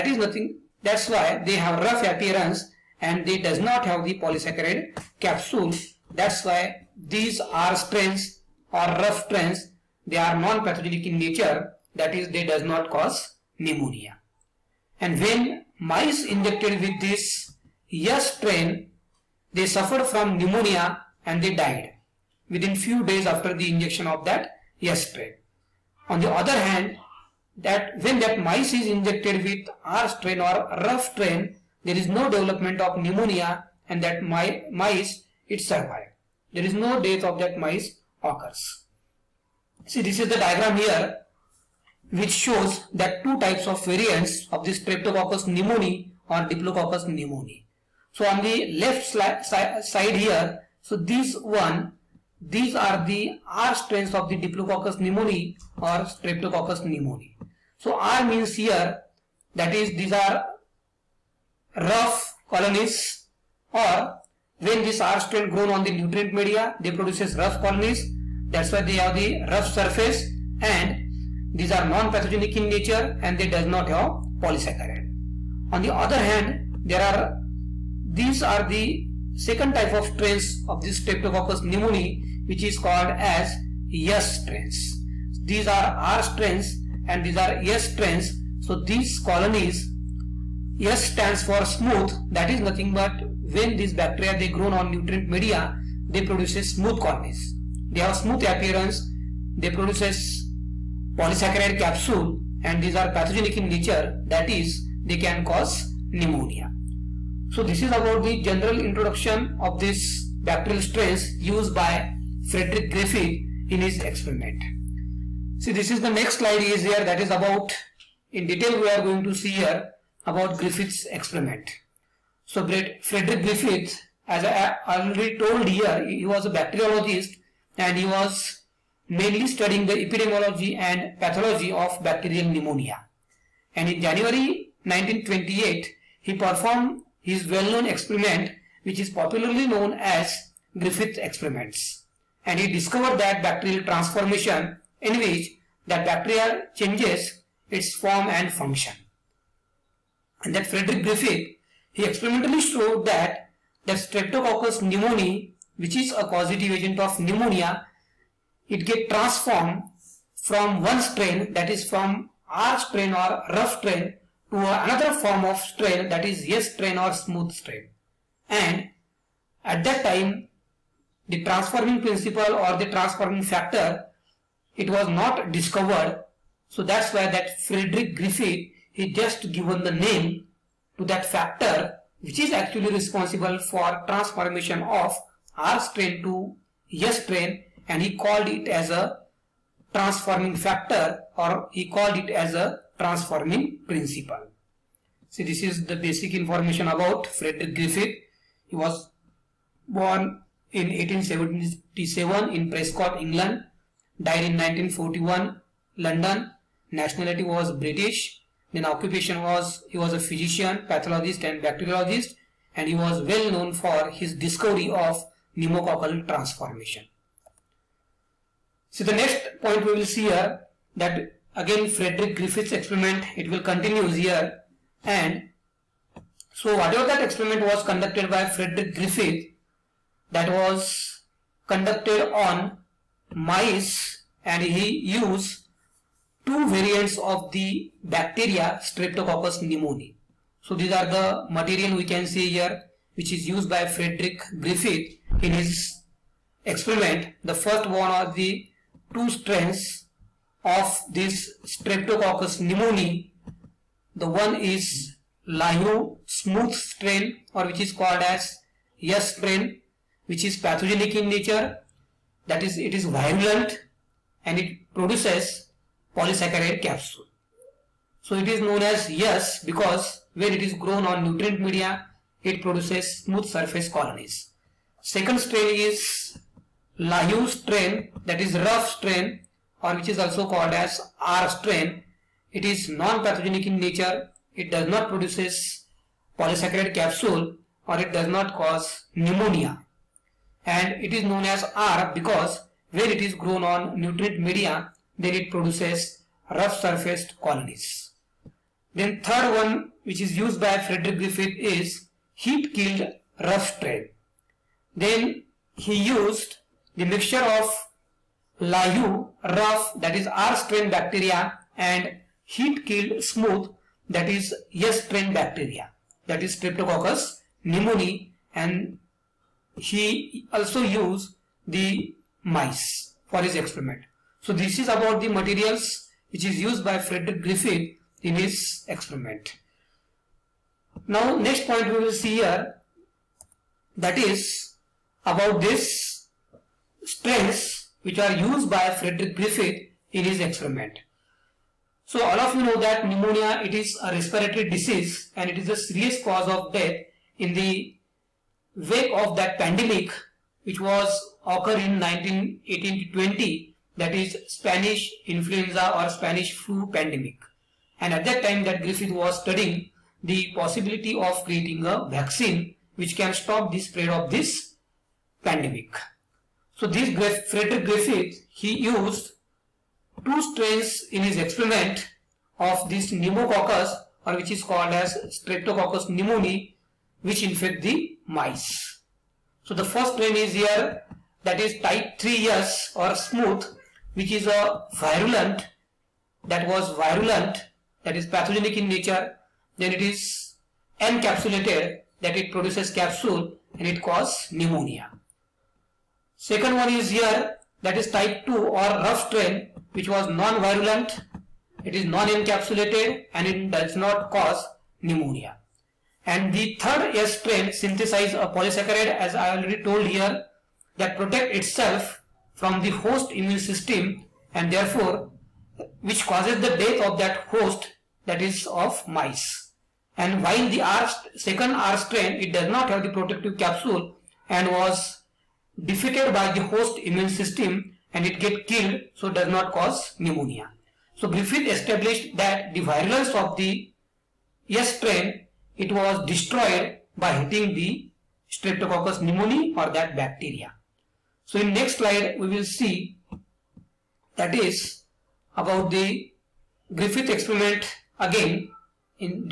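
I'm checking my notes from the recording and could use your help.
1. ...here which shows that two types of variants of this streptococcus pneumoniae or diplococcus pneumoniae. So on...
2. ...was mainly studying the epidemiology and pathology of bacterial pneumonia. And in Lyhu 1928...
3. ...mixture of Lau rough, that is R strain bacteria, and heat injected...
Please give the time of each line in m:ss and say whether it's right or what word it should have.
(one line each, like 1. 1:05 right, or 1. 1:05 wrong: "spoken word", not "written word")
1. 0:40 right
2. 2:08 wrong: "January", not "Lyhu"
3. 5:07 wrong: "killed", not "injected".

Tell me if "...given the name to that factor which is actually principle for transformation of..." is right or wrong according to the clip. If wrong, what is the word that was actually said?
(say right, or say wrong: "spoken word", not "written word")
wrong: "responsible", not "principle".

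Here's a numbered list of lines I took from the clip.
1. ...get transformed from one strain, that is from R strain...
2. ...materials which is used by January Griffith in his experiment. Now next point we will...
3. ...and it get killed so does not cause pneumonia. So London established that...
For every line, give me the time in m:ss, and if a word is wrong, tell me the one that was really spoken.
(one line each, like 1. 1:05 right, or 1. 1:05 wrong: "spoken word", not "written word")
1. 2:38 right
2. 5:25 wrong: "Frederick", not "January"
3. 7:08 wrong: "Griffith", not "London".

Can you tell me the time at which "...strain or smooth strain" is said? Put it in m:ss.
2:46.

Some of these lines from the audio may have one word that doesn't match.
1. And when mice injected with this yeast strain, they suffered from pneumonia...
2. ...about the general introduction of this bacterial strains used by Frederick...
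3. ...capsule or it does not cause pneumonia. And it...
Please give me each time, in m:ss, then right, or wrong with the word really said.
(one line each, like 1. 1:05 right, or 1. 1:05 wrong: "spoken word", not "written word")
1. 0:15 right
2. 1:47 right
3. 4:46 right.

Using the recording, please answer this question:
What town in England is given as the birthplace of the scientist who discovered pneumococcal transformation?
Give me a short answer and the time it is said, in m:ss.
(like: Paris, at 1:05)
Prescot, at 3:22.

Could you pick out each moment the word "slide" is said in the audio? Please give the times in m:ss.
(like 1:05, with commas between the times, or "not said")
1:56, 7:21.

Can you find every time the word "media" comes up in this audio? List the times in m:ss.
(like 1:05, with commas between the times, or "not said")
1:06, 1:35, 4:31, 4:54.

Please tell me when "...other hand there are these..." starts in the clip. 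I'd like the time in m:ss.
1:15.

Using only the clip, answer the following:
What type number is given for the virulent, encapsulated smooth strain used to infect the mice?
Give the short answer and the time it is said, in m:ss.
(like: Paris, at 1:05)
3, at 6:21.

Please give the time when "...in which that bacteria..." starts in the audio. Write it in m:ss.
2:25.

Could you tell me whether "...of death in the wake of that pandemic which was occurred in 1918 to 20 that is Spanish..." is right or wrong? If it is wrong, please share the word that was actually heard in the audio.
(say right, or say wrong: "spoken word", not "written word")
right.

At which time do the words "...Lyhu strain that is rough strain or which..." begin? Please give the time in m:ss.
4:36.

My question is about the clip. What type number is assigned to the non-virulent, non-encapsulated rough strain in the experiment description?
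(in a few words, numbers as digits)
2.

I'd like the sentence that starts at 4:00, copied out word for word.
So these are the material we can see here which is used by Frederick Griffith in his experiment.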